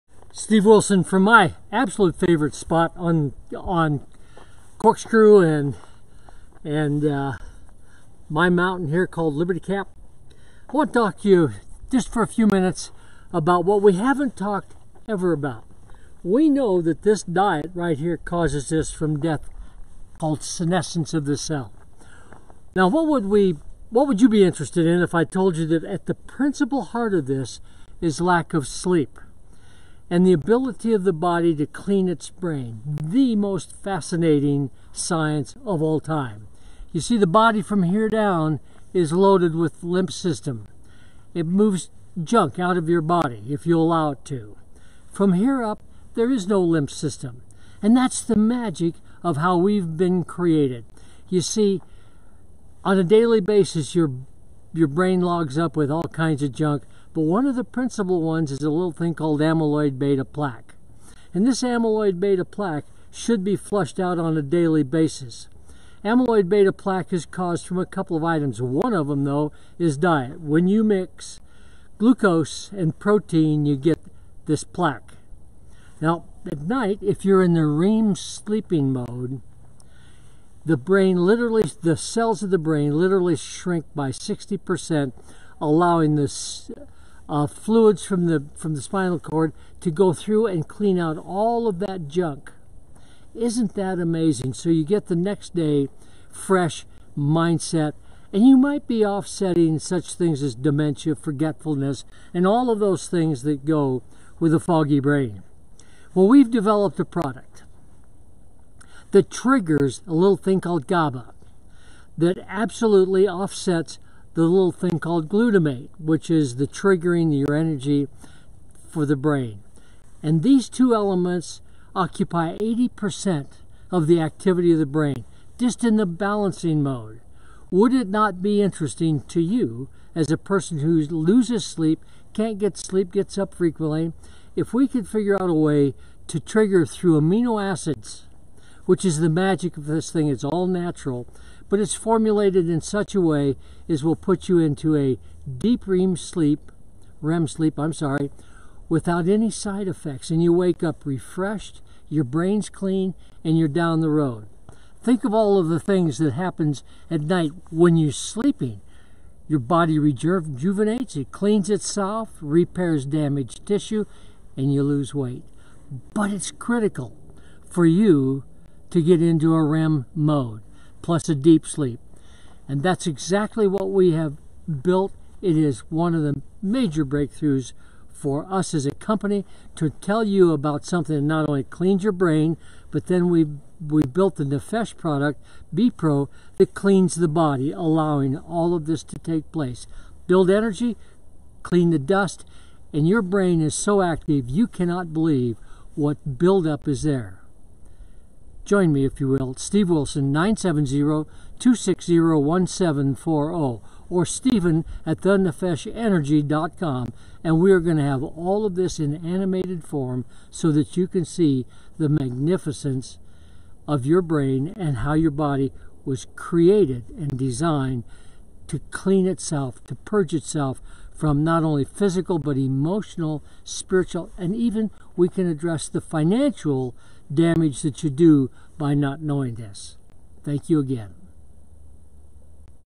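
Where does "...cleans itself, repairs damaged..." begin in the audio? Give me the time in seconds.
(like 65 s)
161 s.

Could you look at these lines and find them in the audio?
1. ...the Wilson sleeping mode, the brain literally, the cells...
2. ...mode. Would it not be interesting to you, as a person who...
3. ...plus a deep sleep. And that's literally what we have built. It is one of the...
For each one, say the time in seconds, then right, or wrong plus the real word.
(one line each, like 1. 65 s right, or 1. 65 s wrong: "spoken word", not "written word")
1. 77 s wrong: "REM", not "Wilson"
2. 126 s right
3. 171 s wrong: "exactly", not "literally".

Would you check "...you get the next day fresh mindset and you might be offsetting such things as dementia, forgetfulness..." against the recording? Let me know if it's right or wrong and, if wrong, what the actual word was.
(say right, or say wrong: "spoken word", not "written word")
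right.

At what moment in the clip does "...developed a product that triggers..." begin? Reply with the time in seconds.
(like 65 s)
106 s.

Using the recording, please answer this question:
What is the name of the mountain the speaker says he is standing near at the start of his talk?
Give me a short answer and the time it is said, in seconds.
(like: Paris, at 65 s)
Liberty Cap, at 9 s.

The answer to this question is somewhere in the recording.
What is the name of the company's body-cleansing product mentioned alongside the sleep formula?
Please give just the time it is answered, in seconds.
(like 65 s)
185 s.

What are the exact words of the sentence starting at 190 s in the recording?
Build energy, clean the dust, and your brain is so active you cannot believe what buildup is there.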